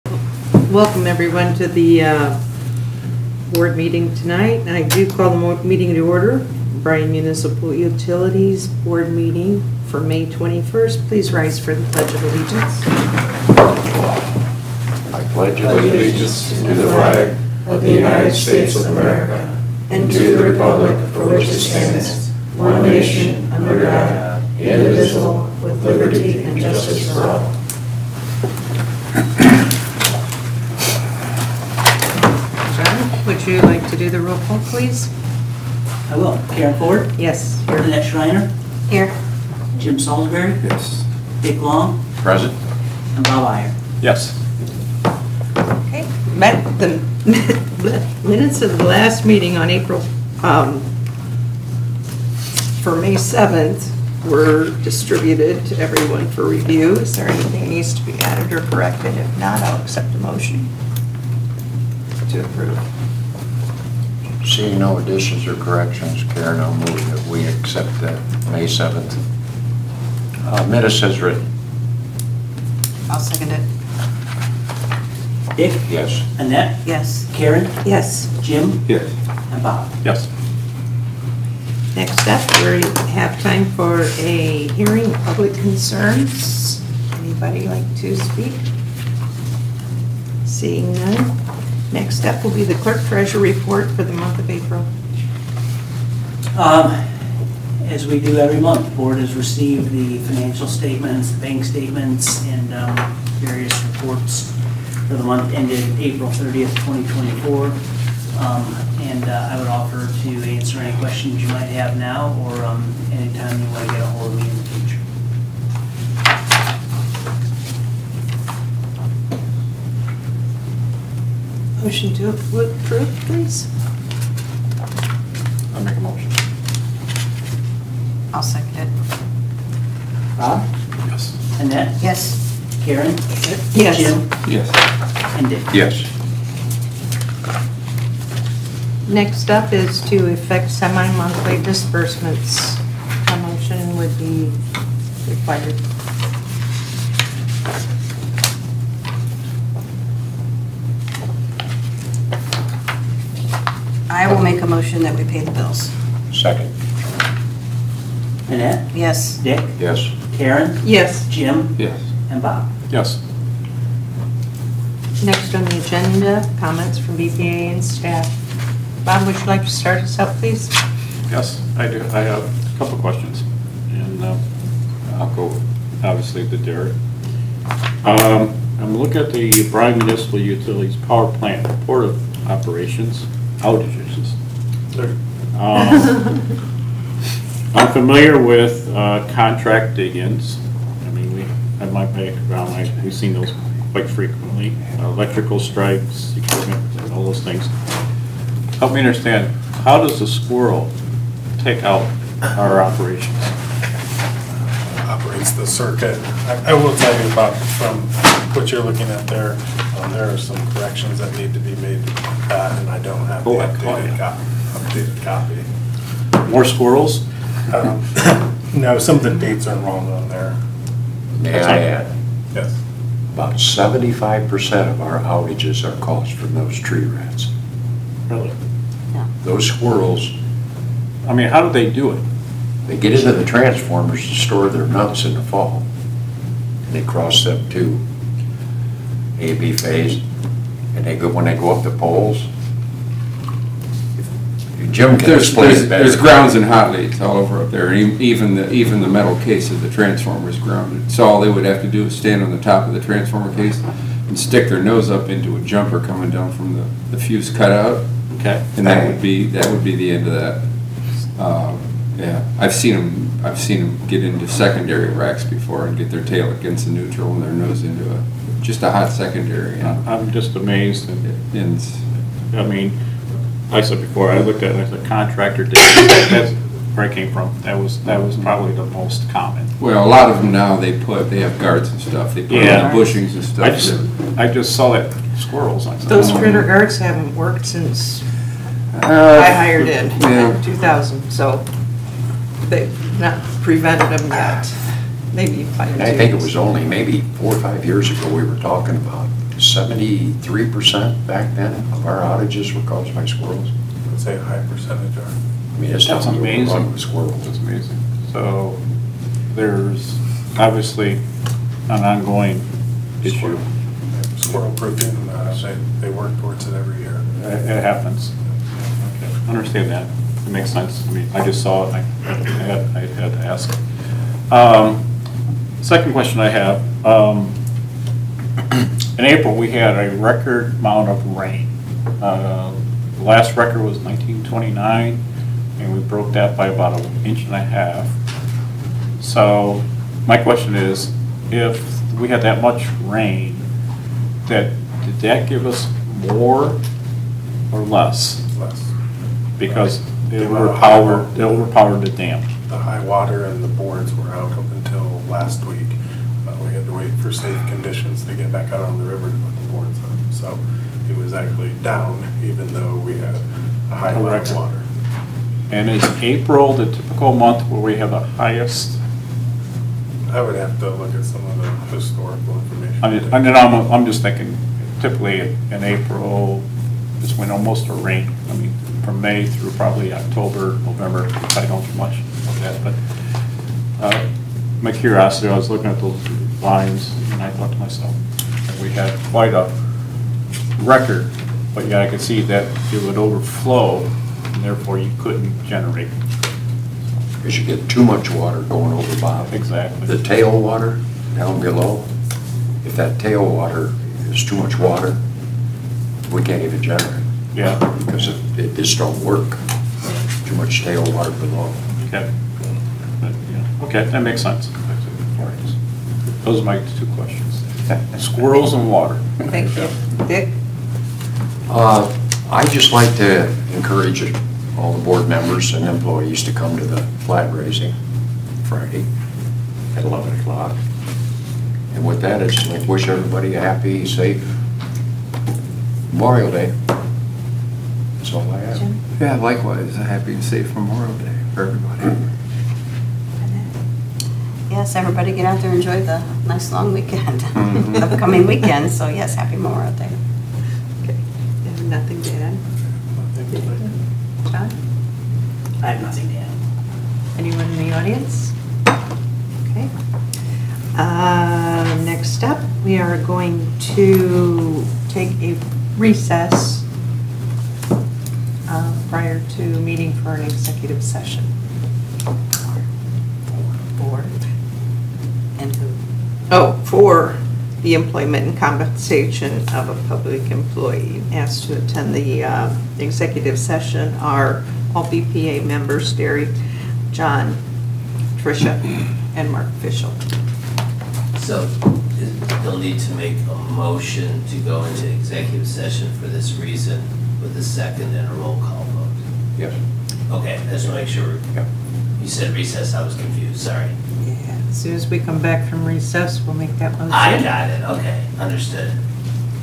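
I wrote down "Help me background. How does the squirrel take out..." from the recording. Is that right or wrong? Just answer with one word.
wrong.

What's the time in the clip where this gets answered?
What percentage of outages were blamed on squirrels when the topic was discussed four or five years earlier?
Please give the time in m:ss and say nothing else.
4:59.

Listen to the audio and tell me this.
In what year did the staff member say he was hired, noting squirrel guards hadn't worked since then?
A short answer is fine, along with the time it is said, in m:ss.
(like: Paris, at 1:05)
2000, at 4:50.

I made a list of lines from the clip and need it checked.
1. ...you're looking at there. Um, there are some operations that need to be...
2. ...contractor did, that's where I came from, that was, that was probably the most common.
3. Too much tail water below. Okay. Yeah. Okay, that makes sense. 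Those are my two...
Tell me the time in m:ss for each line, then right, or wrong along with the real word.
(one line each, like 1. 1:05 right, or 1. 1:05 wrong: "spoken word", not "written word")
1. 3:28 wrong: "corrections", not "operations"
2. 4:35 right
3. 6:50 right.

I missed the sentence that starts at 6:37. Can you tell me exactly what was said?
Because you get too much water going over, Bob.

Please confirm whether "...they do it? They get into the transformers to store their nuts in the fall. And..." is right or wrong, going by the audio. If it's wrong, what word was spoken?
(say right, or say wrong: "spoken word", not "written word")
right.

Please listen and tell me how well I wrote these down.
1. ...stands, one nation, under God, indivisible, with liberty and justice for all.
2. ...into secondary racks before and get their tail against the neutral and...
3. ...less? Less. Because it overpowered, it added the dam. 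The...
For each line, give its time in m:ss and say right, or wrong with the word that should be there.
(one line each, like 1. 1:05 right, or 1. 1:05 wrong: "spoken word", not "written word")
1. 0:21 right
2. 4:24 right
3. 5:47 wrong: "overpowered", not "added".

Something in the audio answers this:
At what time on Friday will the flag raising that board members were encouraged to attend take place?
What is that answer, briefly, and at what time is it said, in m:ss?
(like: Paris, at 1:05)
11 o'clock, at 7:10.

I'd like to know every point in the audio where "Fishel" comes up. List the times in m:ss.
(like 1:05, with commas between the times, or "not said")
8:09.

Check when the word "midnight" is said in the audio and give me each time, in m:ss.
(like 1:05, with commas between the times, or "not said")
not said.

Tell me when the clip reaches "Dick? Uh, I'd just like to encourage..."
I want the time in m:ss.
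7:00.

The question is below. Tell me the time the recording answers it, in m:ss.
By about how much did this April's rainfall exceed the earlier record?
5:36.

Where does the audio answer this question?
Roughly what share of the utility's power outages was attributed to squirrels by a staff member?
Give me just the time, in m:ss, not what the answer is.
3:43.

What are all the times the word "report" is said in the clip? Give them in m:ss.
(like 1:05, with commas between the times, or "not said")
1:33, 1:43, 3:01.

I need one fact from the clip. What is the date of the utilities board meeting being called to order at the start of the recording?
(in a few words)
May 21st.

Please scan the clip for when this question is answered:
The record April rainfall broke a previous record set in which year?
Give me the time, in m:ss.
5:33.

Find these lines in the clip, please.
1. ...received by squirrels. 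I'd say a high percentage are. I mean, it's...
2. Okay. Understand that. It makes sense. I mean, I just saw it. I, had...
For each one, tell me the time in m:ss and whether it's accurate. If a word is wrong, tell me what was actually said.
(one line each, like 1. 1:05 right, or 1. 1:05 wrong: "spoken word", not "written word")
1. 5:02 wrong: "caused", not "received"
2. 5:18 right.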